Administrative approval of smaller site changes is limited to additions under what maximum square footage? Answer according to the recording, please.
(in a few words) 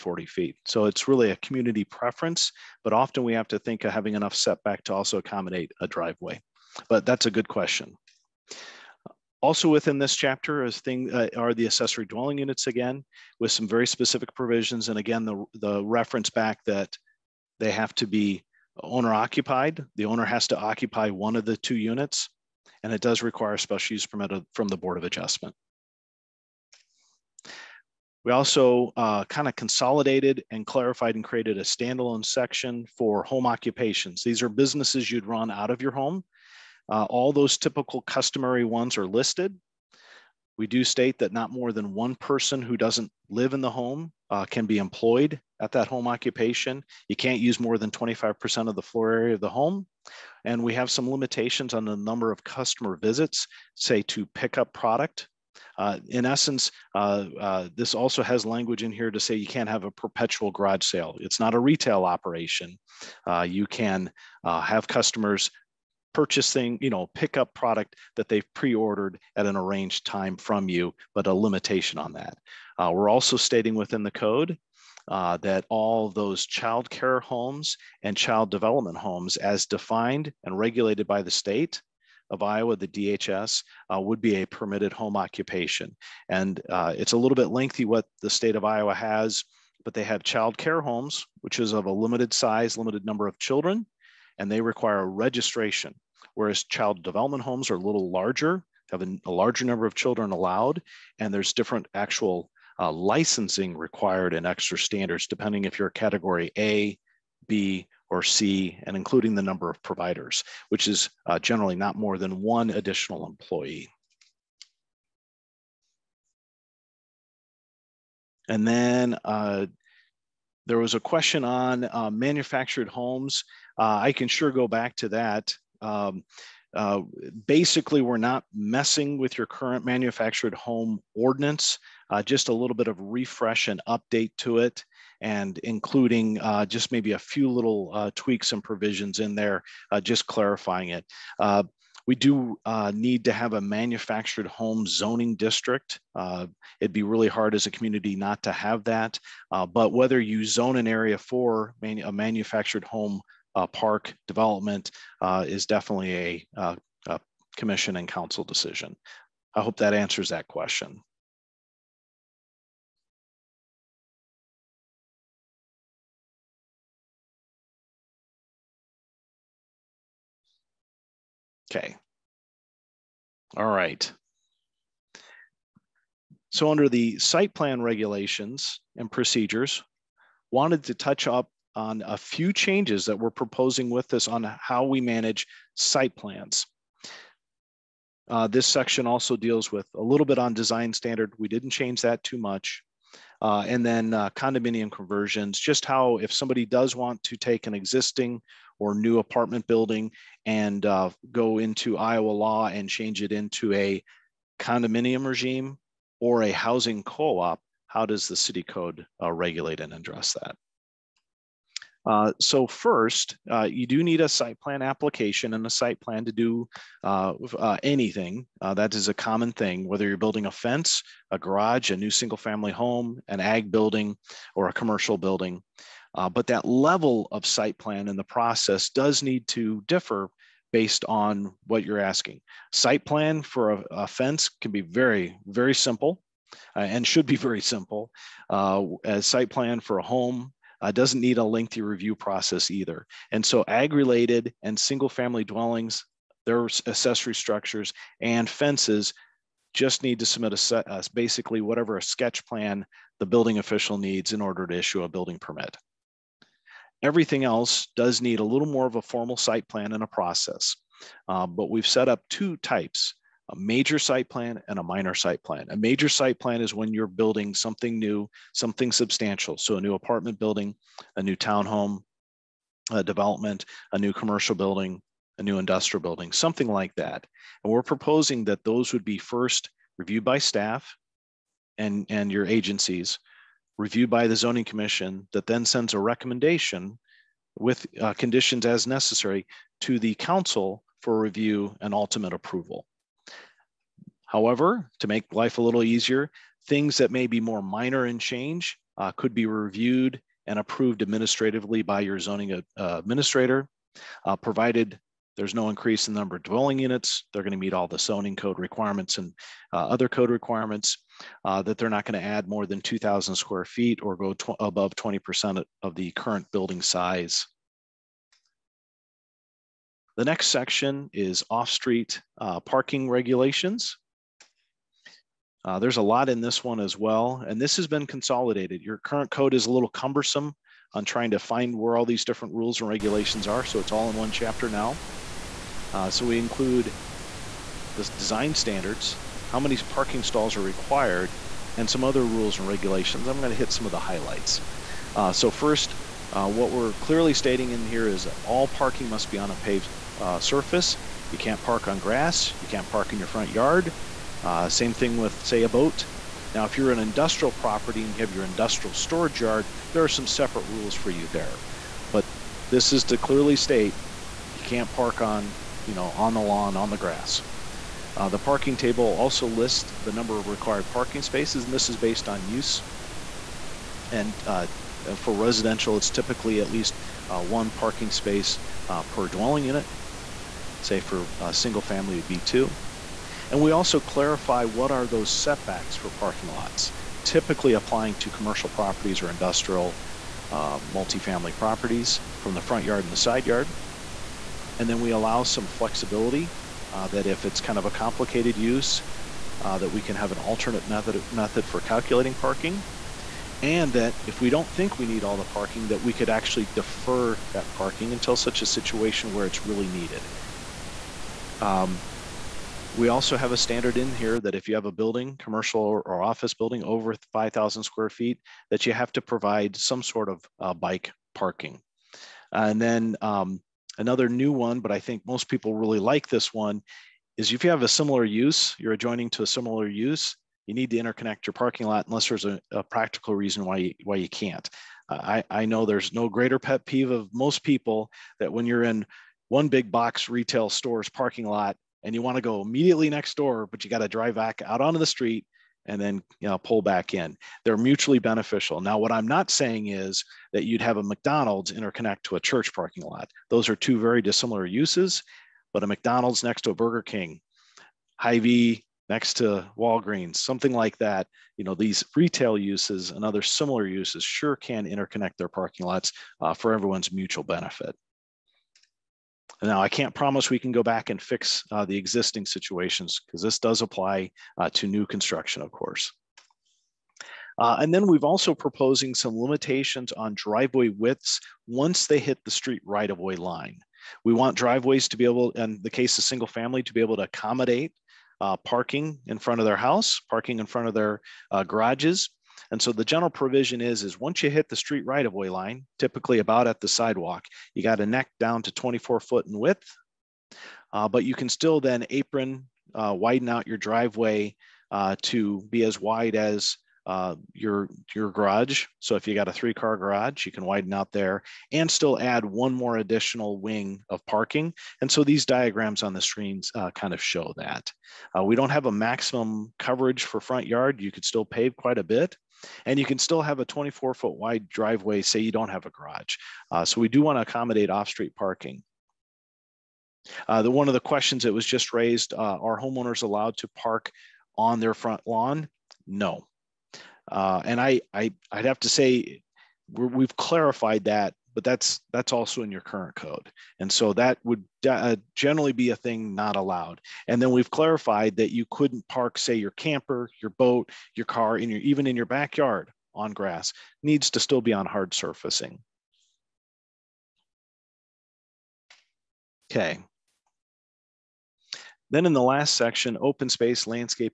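2,000 square feet.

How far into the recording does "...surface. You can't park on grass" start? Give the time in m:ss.
5:50.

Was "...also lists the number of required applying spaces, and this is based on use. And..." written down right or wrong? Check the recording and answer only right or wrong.
wrong.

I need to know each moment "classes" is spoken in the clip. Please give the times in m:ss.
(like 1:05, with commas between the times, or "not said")
not said.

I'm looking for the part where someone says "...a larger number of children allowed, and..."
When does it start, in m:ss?
1:39.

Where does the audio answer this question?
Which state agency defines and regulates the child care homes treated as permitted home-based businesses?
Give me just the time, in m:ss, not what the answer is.
1:22.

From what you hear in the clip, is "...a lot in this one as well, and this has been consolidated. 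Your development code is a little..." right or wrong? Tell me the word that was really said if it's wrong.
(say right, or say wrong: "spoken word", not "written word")
wrong: "current", not "development".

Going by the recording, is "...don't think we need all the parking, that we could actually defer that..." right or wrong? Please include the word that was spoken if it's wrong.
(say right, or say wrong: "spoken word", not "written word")
right.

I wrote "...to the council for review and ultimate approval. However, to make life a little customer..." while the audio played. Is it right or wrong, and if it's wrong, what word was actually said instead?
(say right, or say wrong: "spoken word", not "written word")
wrong: "easier", not "customer".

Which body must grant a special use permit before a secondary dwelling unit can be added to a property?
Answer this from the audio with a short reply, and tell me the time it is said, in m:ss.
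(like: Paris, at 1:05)
Board of Adjustment, at 0:24.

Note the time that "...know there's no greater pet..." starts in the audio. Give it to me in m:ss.
7:15.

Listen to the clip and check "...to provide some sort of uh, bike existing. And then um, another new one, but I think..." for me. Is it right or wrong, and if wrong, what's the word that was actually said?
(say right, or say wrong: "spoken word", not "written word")
wrong: "parking", not "existing".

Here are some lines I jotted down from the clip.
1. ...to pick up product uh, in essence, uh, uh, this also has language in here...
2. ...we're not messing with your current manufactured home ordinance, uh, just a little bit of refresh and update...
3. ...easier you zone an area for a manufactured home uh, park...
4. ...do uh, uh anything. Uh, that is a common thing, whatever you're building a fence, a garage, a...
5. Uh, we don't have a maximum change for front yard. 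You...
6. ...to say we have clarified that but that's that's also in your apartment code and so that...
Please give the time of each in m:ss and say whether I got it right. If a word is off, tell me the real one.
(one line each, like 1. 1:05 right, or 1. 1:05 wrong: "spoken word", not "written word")
1. 0:54 right
2. 2:08 right
3. 2:29 wrong: "whether", not "easier"
4. 3:36 wrong: "whether", not "whatever"
5. 8:38 wrong: "coverage", not "change"
6. 8:58 wrong: "current", not "apartment".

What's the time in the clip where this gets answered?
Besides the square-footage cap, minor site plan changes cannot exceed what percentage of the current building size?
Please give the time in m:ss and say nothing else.
5:14.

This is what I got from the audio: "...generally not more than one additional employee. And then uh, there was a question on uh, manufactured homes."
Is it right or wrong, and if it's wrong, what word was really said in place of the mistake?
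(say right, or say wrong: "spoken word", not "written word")
right.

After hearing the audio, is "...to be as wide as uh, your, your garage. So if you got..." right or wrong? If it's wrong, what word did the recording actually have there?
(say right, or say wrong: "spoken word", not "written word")
right.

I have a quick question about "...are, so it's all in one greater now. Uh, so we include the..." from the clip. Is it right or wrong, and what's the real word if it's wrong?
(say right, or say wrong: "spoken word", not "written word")
wrong: "chapter", not "greater".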